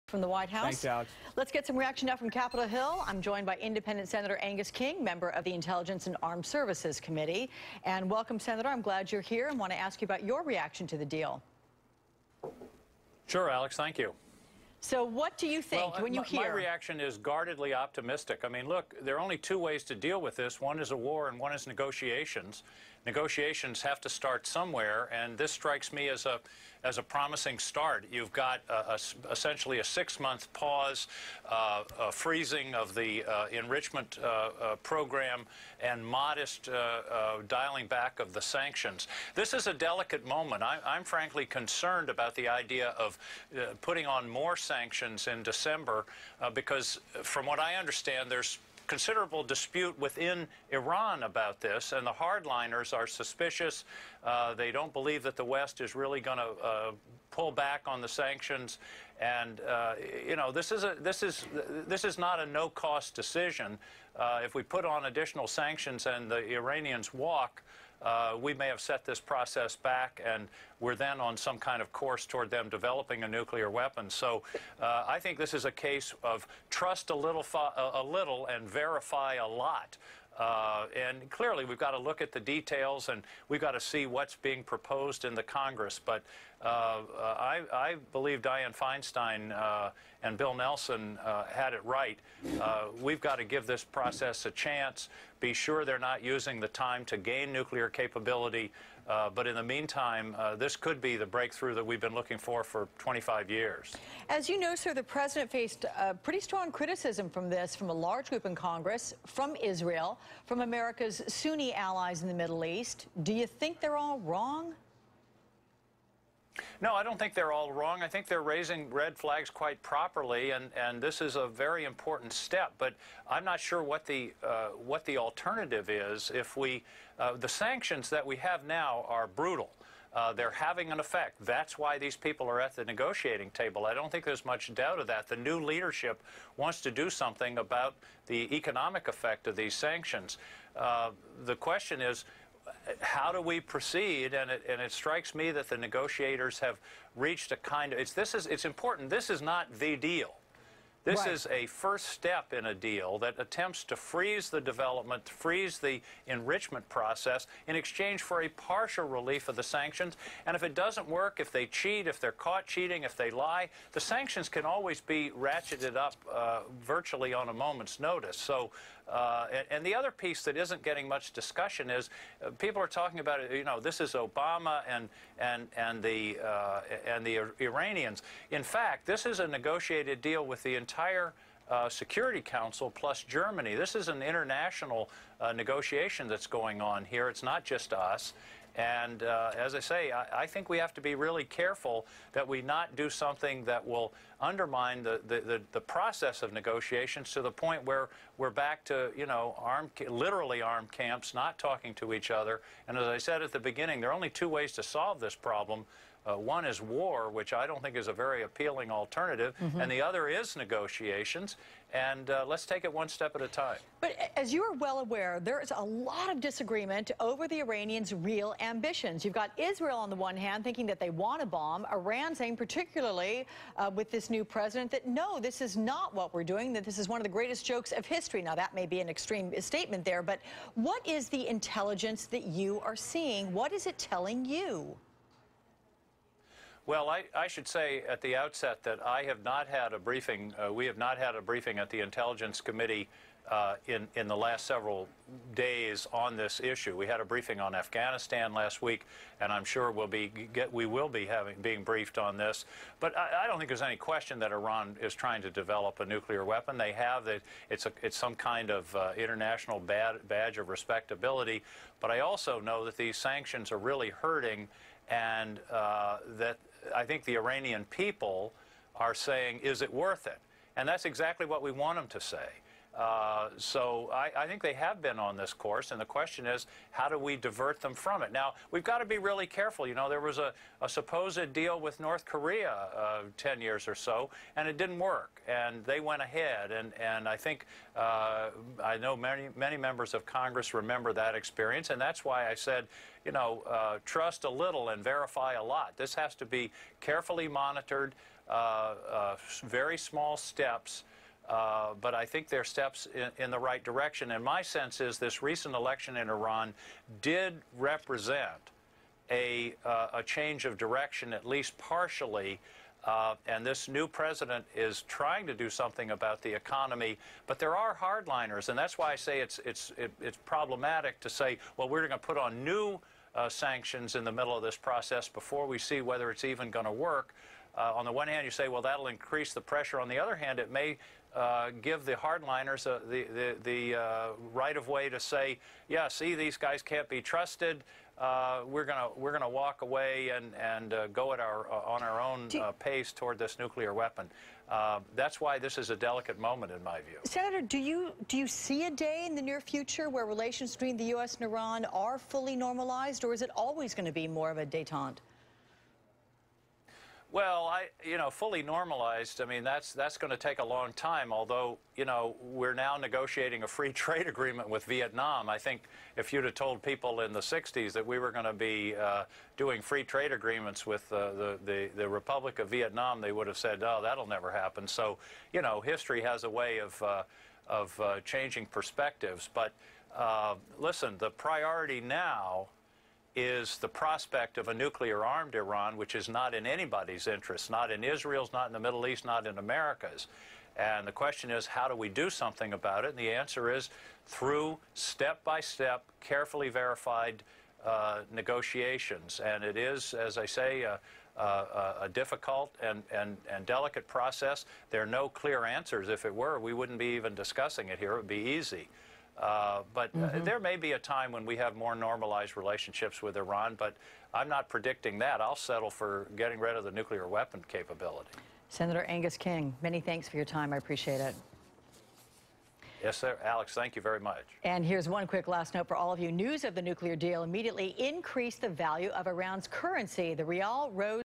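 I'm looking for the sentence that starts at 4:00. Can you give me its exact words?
Uh, we have not had a briefing at the Intelligence Committee uh, in, in the last several days on this issue.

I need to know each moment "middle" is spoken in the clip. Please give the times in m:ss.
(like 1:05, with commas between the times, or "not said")
1:52, 5:24, 6:28.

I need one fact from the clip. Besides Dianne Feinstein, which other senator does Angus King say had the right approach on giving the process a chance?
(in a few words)
Bill Nelson.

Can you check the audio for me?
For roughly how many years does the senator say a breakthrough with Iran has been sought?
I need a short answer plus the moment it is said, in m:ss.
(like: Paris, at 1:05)
25 years, at 1:42.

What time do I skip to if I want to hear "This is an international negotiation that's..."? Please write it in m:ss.
3:03.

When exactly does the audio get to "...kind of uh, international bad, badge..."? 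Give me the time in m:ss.
4:18.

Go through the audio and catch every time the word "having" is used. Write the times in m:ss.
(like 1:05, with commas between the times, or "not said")
2:10, 4:11.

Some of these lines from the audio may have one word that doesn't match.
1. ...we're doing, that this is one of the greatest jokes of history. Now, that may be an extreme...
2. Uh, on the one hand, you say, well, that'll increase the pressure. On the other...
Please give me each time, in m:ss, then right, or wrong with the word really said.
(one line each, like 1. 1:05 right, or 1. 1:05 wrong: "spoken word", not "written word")
1. 3:46 right
2. 5:27 right.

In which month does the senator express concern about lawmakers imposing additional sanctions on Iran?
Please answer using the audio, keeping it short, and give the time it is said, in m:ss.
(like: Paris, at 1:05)
December, at 0:45.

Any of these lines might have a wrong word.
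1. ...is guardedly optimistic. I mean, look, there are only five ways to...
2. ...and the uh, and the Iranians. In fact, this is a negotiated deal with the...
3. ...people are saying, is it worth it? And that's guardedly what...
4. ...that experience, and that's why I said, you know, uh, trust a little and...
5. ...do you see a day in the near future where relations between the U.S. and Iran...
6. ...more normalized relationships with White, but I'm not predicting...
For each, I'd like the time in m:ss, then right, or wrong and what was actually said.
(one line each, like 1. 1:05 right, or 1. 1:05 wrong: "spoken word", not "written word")
1. 0:16 wrong: "two", not "five"
2. 2:55 right
3. 4:27 wrong: "exactly", not "guardedly"
4. 4:51 right
5. 5:48 right
6. 6:51 wrong: "Iran", not "White".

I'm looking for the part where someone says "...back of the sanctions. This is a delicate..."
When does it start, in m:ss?
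0:37.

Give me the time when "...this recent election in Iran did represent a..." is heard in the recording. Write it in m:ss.
5:05.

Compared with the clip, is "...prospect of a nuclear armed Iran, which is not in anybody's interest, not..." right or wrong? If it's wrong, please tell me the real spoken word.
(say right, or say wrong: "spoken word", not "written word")
right.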